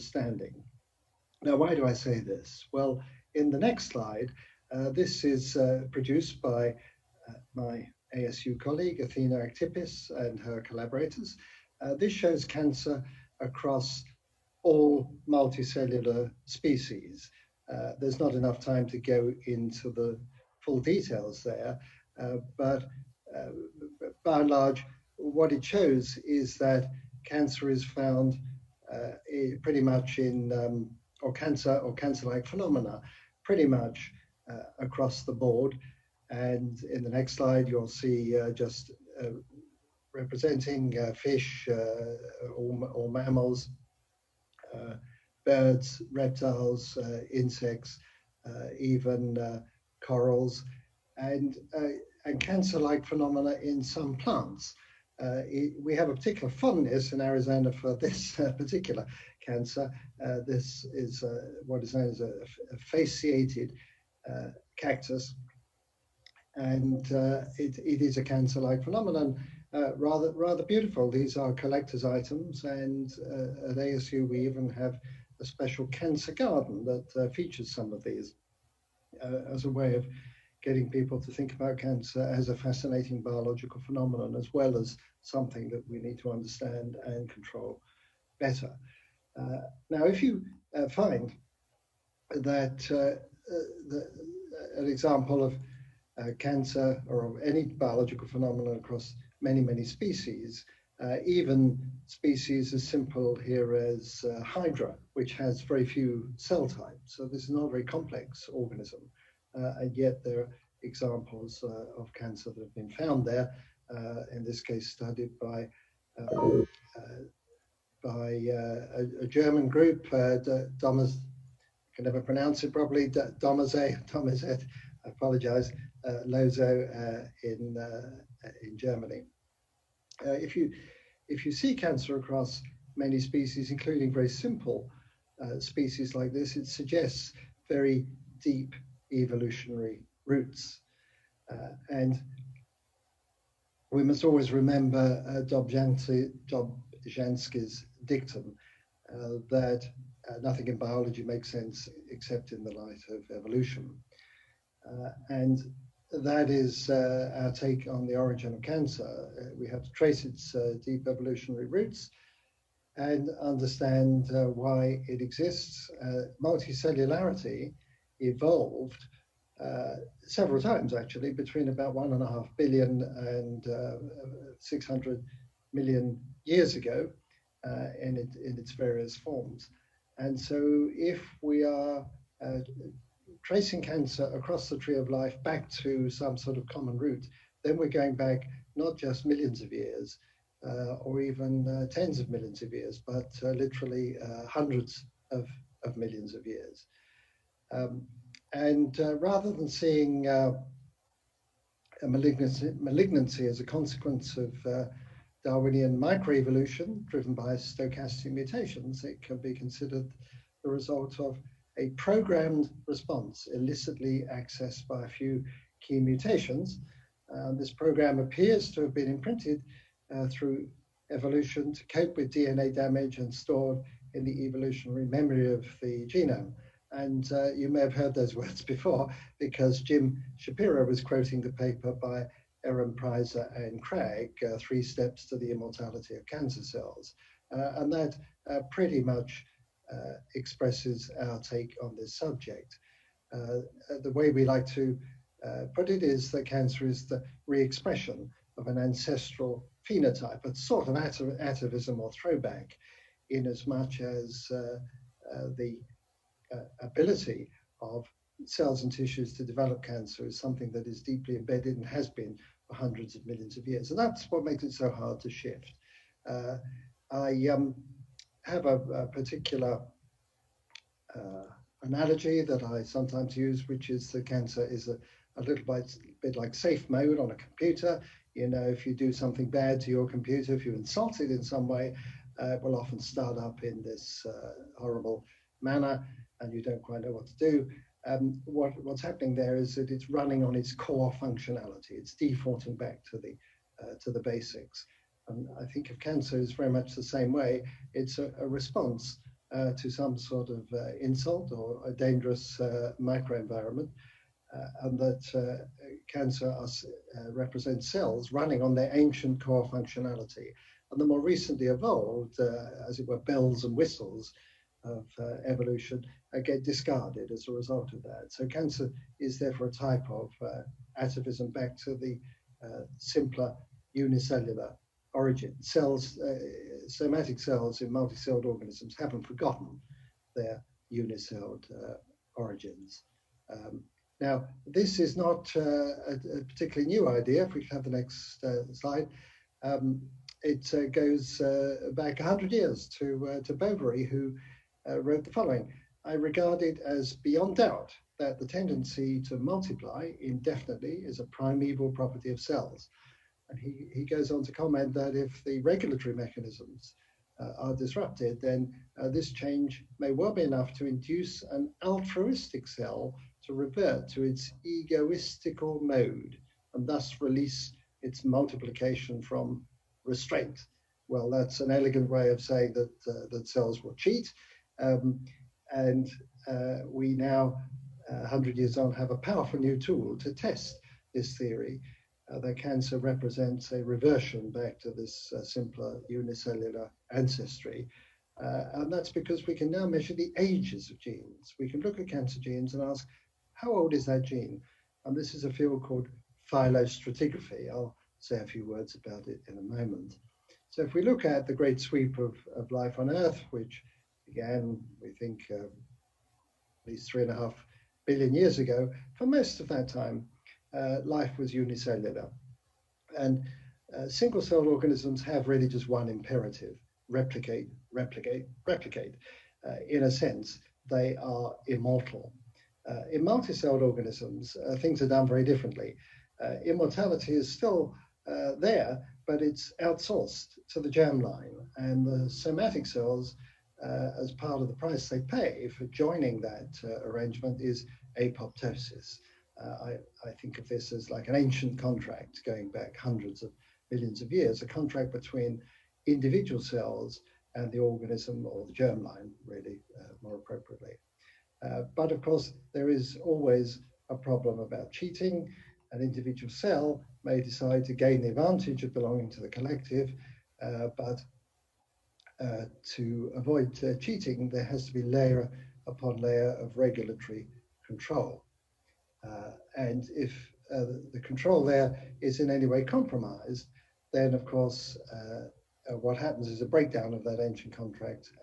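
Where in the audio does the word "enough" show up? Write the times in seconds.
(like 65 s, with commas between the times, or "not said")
18 s, 360 s.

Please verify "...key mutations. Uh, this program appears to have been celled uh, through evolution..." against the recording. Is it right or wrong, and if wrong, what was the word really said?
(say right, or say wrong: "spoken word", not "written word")
wrong: "imprinted", not "celled".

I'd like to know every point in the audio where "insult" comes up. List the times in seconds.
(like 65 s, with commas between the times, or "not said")
280 s, 301 s.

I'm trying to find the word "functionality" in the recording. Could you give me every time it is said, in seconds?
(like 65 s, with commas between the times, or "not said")
291 s, 309 s.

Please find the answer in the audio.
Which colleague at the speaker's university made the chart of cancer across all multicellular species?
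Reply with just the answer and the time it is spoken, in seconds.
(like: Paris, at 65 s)
Athena Aktipis, at 9 s.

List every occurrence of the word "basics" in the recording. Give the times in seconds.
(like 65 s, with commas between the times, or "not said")
294 s.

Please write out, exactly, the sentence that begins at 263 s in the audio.
And that's what makes it so hard to shift.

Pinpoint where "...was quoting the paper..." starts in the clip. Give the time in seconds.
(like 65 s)
230 s.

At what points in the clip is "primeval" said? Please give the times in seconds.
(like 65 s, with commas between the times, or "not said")
351 s.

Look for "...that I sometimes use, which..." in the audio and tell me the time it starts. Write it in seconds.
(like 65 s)
272 s.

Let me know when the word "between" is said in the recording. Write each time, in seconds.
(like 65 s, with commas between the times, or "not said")
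171 s, 445 s.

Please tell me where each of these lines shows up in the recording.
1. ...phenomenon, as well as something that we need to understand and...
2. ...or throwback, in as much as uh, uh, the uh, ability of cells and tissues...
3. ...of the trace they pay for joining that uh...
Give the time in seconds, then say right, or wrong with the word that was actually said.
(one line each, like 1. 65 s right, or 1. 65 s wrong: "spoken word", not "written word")
1. 83 s right
2. 251 s right
3. 434 s wrong: "price", not "trace".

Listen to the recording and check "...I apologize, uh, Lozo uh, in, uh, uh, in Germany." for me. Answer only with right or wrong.
right.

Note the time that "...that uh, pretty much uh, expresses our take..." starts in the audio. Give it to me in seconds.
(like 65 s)
237 s.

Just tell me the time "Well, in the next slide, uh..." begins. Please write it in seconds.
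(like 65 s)
2 s.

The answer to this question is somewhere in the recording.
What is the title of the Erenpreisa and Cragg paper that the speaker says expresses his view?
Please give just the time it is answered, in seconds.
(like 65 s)
234 s.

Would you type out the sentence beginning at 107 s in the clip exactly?
So this is not a very complex organism, and yet there are examples uh, of cancer that have been found there.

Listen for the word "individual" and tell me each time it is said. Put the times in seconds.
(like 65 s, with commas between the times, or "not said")
446 s, 456 s.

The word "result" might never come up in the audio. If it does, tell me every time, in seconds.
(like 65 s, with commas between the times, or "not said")
210 s, 317 s.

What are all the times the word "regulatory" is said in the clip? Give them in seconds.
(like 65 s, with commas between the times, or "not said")
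355 s, 466 s.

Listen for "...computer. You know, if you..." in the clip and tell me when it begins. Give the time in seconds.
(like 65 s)
277 s.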